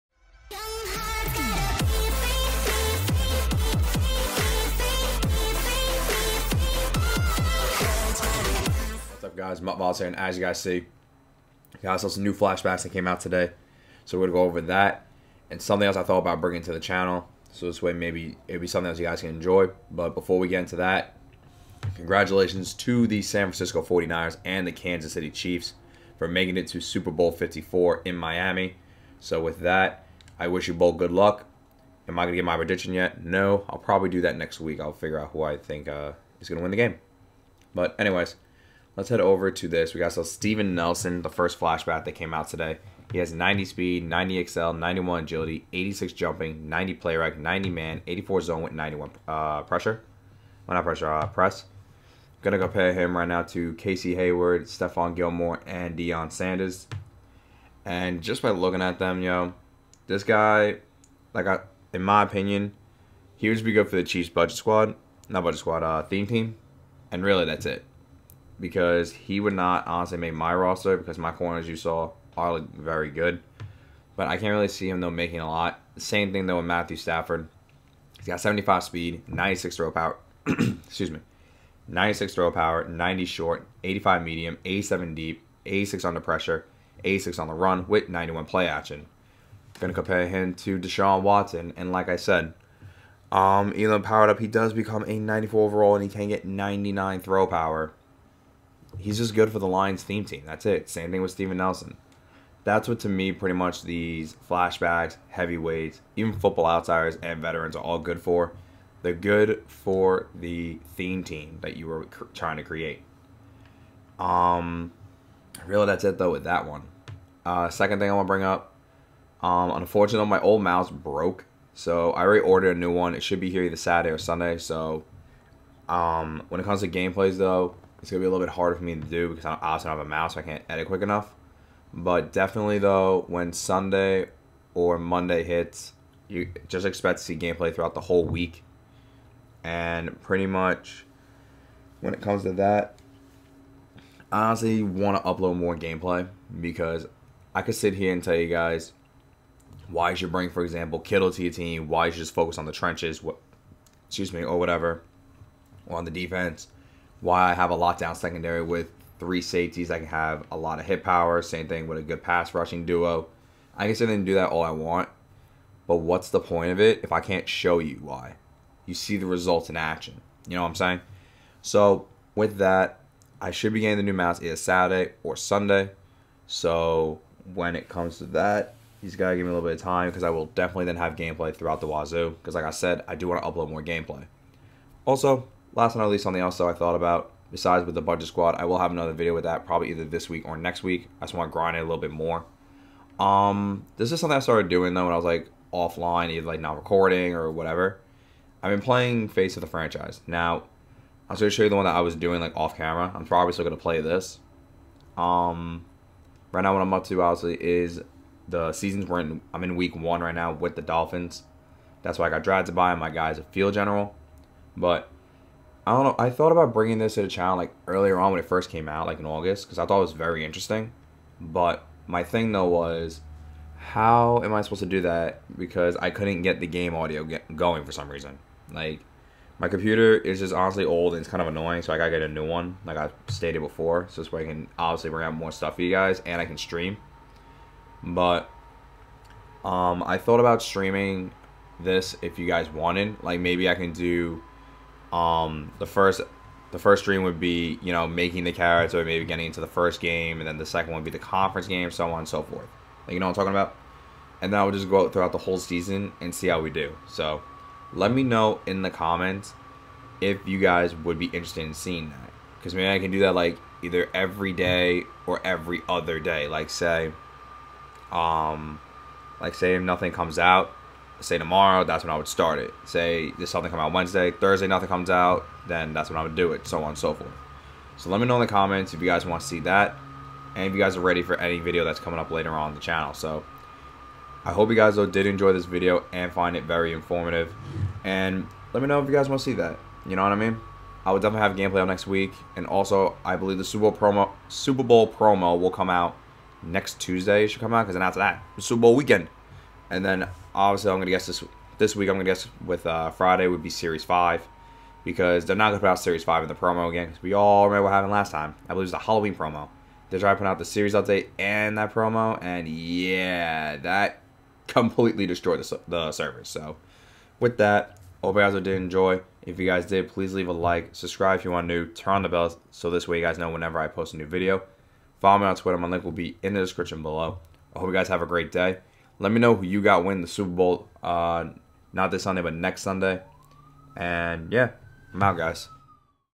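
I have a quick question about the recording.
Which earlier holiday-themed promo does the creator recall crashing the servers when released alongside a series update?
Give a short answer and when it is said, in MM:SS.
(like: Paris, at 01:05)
Halloween promo, at 05:08.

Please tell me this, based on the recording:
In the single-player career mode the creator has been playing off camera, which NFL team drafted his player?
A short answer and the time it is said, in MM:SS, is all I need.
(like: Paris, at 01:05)
Dolphins, at 03:30.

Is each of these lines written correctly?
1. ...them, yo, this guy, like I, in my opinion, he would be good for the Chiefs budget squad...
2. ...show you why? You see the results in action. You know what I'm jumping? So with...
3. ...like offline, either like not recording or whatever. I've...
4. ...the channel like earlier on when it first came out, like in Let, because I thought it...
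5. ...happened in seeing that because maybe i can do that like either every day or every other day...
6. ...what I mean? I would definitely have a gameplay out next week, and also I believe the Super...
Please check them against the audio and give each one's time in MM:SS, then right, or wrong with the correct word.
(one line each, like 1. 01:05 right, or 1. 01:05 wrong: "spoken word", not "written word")
1. 00:58 right
2. 02:47 wrong: "saying", not "jumping"
3. 03:15 right
4. 03:37 wrong: "August", not "Let"
5. 04:21 wrong: "interested", not "happened"
6. 04:50 right.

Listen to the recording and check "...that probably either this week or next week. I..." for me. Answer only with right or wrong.
right.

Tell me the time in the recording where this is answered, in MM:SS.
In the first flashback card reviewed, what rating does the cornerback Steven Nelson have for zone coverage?
00:48.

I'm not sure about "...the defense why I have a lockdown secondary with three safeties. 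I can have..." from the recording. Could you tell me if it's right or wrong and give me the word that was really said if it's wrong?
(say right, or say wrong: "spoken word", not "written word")
right.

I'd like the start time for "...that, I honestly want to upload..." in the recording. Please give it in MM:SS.
02:22.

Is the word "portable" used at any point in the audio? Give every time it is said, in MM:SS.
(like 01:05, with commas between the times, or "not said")
not said.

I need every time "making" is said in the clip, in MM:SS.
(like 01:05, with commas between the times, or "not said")
00:26, 01:15, 04:08.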